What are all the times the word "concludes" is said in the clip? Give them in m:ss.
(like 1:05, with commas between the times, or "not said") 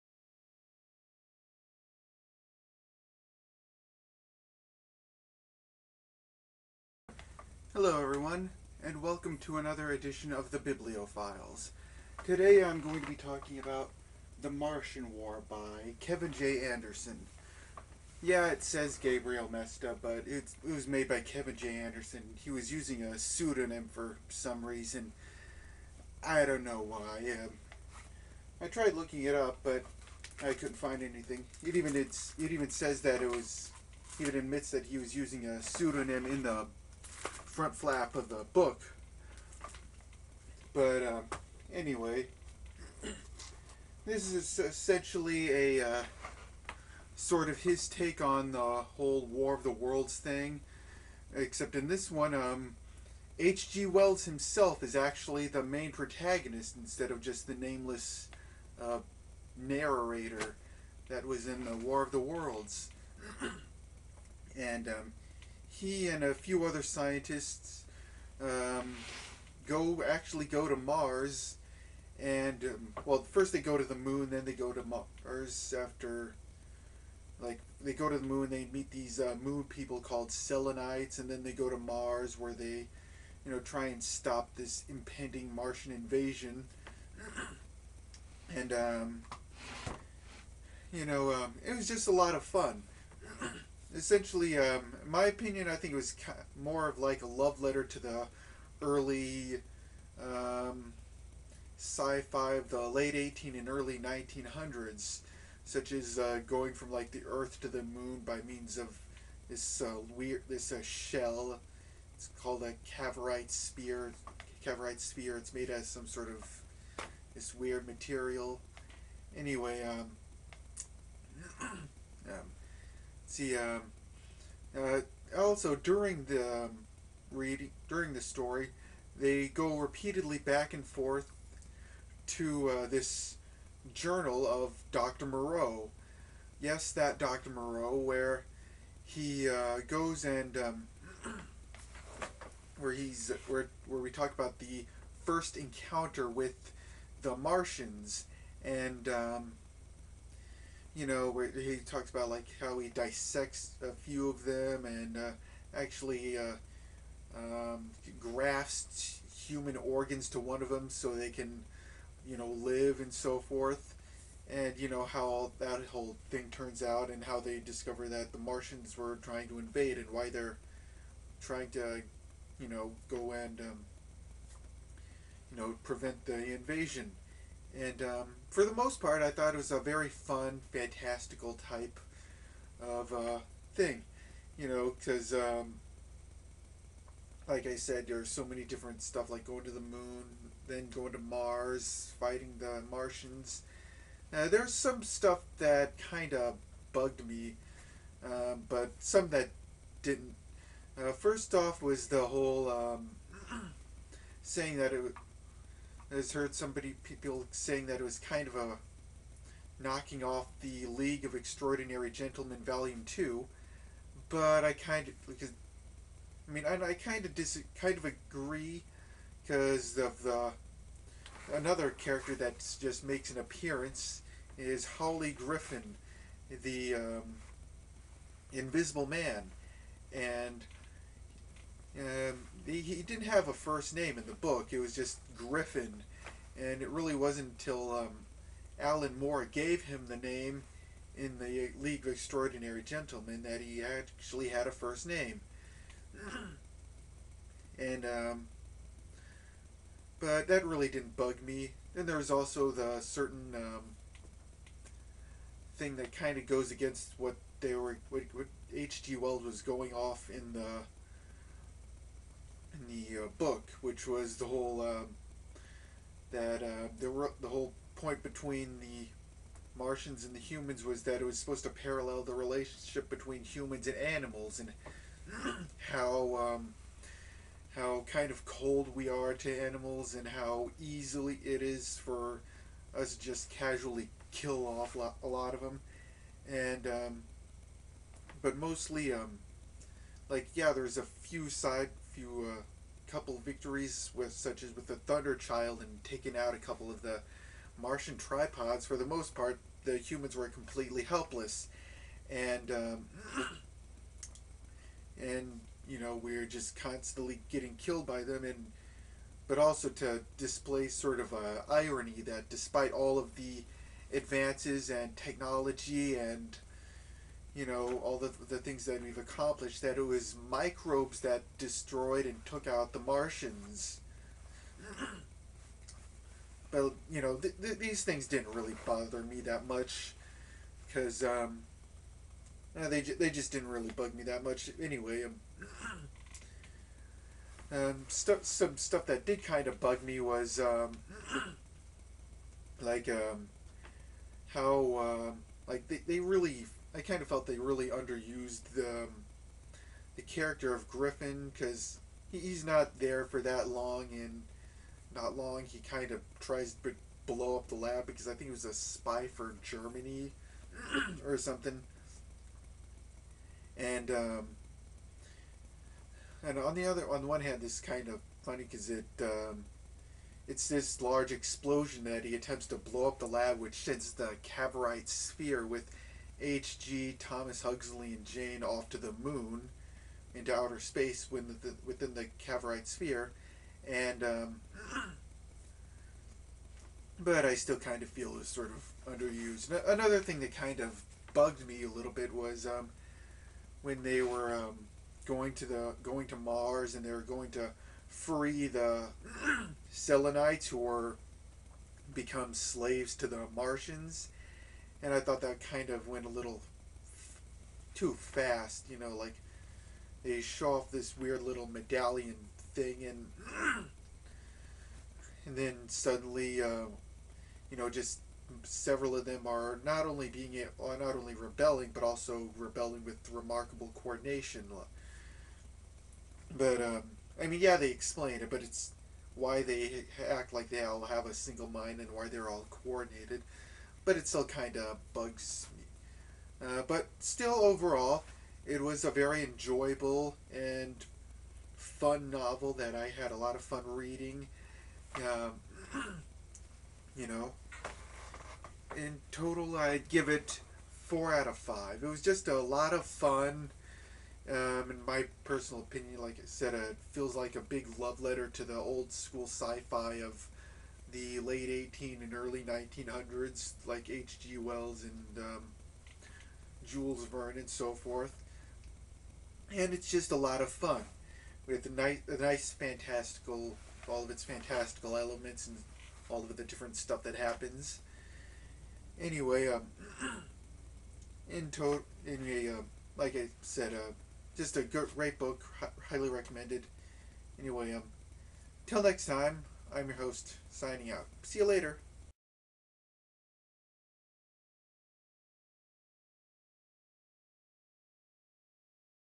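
not said.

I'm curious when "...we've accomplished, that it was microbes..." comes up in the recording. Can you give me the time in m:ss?
5:19.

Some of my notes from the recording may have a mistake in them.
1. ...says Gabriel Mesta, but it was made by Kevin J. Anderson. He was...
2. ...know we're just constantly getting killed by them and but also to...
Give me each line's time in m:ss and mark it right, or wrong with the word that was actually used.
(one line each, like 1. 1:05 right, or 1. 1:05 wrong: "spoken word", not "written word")
1. 0:18 right
2. 5:05 right.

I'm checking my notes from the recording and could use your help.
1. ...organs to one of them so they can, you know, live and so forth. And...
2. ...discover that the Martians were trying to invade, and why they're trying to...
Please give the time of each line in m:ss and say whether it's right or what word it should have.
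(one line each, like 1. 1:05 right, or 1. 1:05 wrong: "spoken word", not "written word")
1. 2:39 right
2. 2:47 right.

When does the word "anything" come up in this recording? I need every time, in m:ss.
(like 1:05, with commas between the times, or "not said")
0:31.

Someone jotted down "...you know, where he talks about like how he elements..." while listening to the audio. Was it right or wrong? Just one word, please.
wrong.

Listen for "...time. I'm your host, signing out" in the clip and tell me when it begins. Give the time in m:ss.
8:09.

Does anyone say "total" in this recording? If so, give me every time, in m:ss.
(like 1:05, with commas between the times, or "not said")
7:29, 8:01.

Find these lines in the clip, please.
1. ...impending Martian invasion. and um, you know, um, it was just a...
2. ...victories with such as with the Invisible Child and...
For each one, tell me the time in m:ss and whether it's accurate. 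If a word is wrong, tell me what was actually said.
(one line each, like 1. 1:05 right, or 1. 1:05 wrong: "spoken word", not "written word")
1. 1:24 right
2. 4:53 wrong: "Thunder", not "Invisible".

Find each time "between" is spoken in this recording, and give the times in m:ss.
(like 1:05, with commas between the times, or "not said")
4:28, 4:33.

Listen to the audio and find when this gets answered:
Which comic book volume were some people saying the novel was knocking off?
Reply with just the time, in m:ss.
3:30.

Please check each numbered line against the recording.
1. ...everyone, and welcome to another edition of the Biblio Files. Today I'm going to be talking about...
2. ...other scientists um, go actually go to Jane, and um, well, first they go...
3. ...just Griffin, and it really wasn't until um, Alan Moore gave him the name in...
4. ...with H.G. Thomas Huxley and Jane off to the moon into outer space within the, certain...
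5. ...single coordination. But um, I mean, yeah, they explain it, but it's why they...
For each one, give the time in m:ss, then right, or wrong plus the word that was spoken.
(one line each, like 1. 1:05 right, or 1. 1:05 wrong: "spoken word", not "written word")
1. 0:08 right
2. 1:06 wrong: "Mars", not "Jane"
3. 3:54 right
4. 6:15 wrong: "within", not "certain"
5. 7:03 wrong: "remarkable", not "single".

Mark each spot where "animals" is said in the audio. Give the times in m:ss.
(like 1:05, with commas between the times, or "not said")
4:33, 4:39.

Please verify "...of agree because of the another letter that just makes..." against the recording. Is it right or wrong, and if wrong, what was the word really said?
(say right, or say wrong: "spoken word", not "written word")
wrong: "character", not "letter".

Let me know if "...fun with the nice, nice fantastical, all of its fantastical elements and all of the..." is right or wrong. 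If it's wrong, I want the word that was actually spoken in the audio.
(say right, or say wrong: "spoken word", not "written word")
right.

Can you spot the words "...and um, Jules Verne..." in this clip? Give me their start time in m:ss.
7:45.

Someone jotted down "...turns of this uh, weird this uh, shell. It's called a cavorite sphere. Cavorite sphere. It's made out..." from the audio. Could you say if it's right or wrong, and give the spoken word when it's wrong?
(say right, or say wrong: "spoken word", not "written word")
wrong: "means", not "turns".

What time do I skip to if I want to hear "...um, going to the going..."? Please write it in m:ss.
6:34.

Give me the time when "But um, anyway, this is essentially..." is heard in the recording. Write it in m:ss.
0:40.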